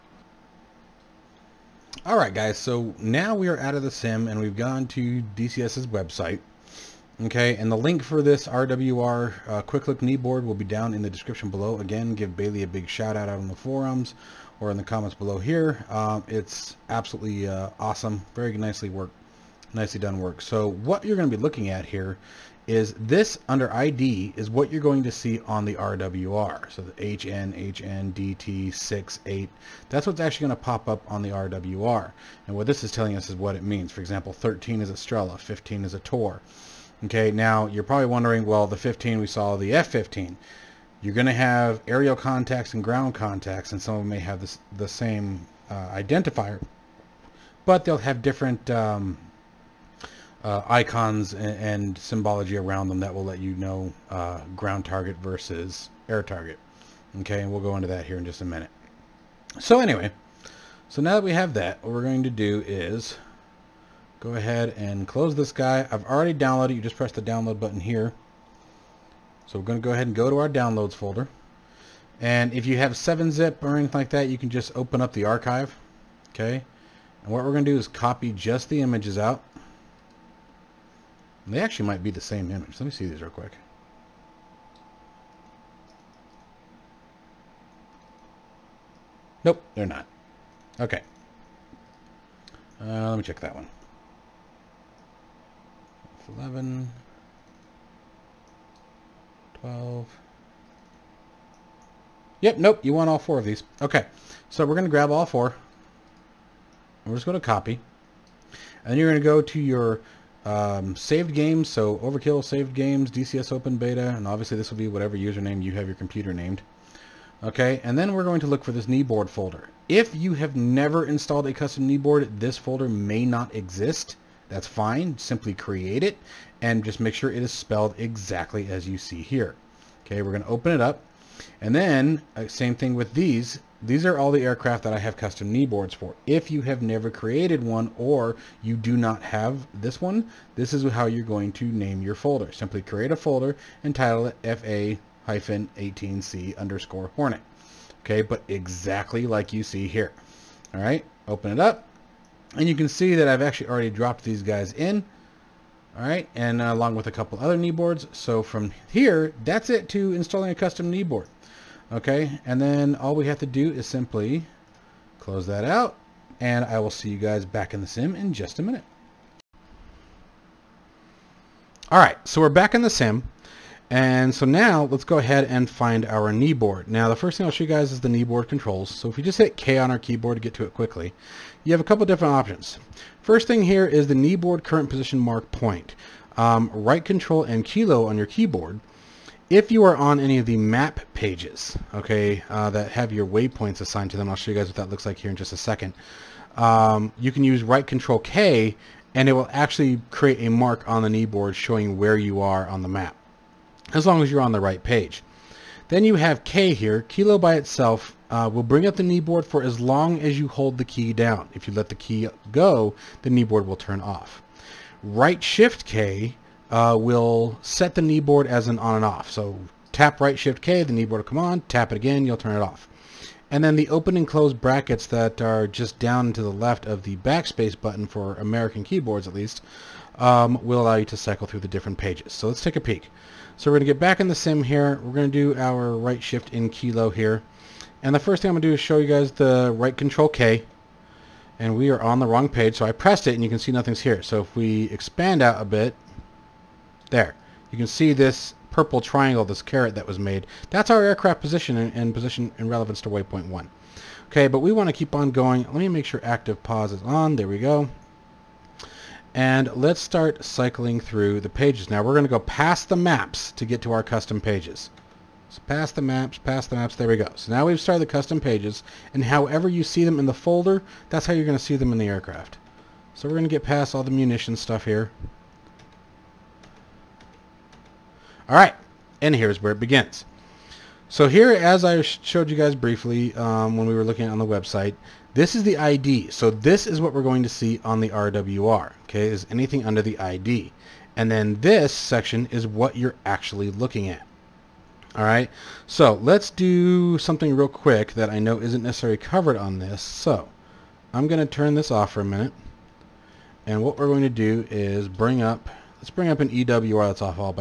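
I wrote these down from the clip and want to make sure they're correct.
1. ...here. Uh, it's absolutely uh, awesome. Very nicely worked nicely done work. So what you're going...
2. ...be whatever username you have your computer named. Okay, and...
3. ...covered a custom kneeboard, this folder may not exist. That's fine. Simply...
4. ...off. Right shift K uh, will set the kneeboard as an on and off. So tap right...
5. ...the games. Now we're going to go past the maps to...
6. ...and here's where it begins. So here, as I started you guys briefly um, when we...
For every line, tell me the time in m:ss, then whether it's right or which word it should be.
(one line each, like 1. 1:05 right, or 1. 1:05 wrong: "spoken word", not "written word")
1. 0:15 right
2. 1:54 right
3. 2:01 wrong: "installed", not "covered"
4. 3:33 right
5. 4:21 wrong: "pages", not "games"
6. 4:39 wrong: "showed", not "started".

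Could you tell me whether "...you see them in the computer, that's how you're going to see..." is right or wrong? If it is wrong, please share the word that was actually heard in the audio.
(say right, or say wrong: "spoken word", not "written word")
wrong: "folder", not "computer".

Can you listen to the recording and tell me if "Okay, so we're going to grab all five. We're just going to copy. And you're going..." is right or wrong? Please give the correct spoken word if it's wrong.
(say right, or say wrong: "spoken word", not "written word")
wrong: "four", not "five".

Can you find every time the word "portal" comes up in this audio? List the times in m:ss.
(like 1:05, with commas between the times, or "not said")
not said.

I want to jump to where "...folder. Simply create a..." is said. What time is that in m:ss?
2:22.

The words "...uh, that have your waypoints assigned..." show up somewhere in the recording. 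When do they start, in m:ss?
3:12.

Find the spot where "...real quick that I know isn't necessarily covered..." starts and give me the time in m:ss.
4:57.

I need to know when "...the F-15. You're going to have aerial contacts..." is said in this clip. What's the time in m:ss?
0:39.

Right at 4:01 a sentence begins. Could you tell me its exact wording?
And we are on the wrong page.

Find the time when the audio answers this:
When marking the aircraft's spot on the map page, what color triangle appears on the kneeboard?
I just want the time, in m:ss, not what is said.
4:08.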